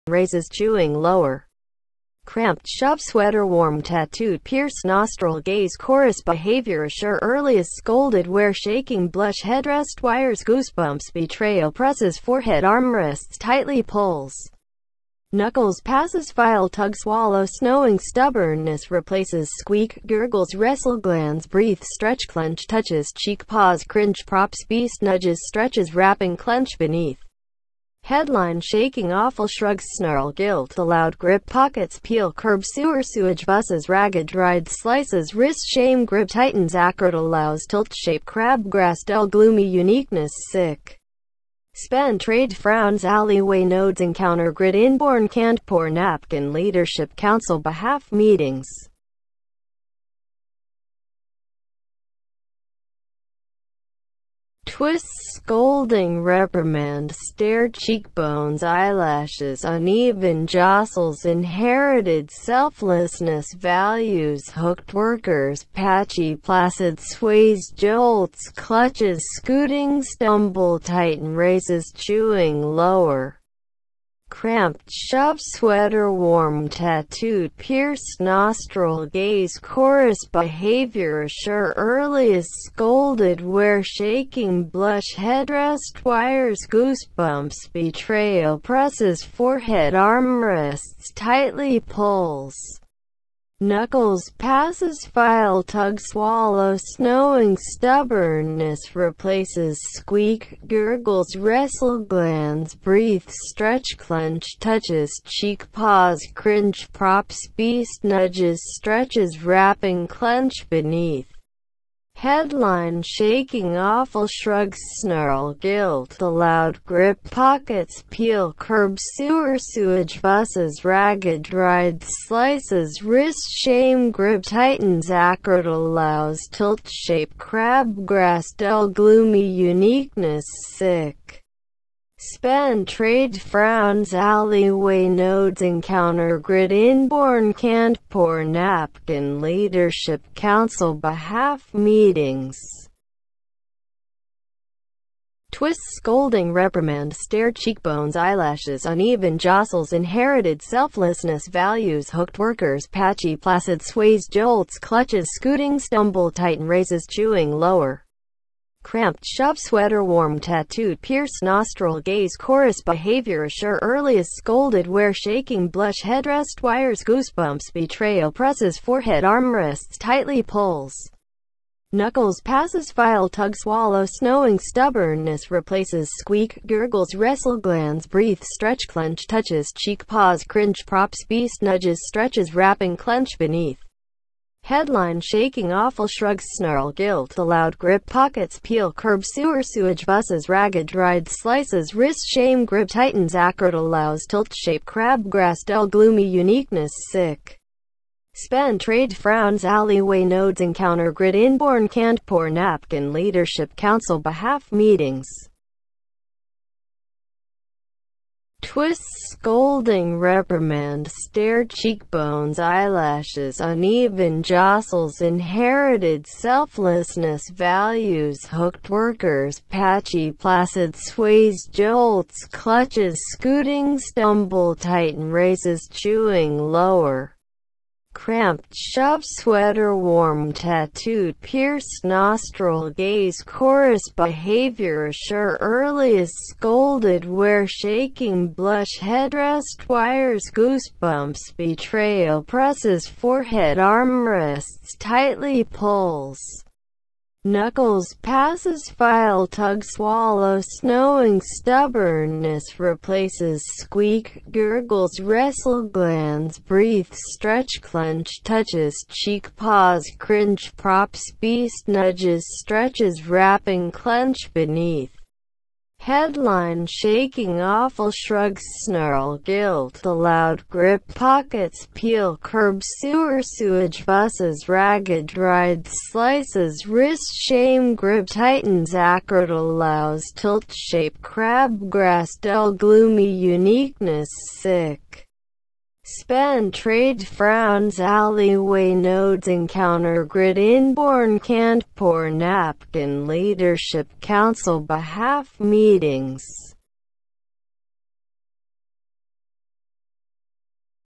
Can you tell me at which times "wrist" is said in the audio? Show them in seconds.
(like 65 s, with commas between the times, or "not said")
35 s, 123 s, 191 s, 276 s.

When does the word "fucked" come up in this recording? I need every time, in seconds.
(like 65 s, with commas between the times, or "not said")
not said.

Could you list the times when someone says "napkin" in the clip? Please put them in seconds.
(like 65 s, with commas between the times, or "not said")
45 s, 138 s, 202 s, 292 s.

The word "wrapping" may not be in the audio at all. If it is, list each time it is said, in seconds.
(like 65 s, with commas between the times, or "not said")
25 s, 109 s, 182 s, 263 s.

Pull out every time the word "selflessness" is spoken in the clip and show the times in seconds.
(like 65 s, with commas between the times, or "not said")
62 s, 150 s, 216 s.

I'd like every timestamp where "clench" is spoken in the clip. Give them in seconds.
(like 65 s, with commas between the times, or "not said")
22 s, 26 s, 103 s, 110 s, 178 s, 182 s, 257 s, 263 s.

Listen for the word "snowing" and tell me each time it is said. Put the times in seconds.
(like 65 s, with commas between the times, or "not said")
17 s, 96 s, 174 s, 250 s.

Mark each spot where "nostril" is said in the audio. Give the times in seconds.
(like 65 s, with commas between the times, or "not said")
4 s, 78 s, 161 s, 232 s.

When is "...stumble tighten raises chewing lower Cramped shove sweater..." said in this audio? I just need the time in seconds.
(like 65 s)
155 s.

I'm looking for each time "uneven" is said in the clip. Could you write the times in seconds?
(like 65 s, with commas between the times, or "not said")
59 s, 148 s, 213 s.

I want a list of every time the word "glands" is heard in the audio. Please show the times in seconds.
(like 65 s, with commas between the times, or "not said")
20 s, 101 s, 177 s, 255 s.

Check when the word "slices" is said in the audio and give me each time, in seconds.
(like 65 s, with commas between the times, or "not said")
34 s, 122 s, 191 s, 276 s.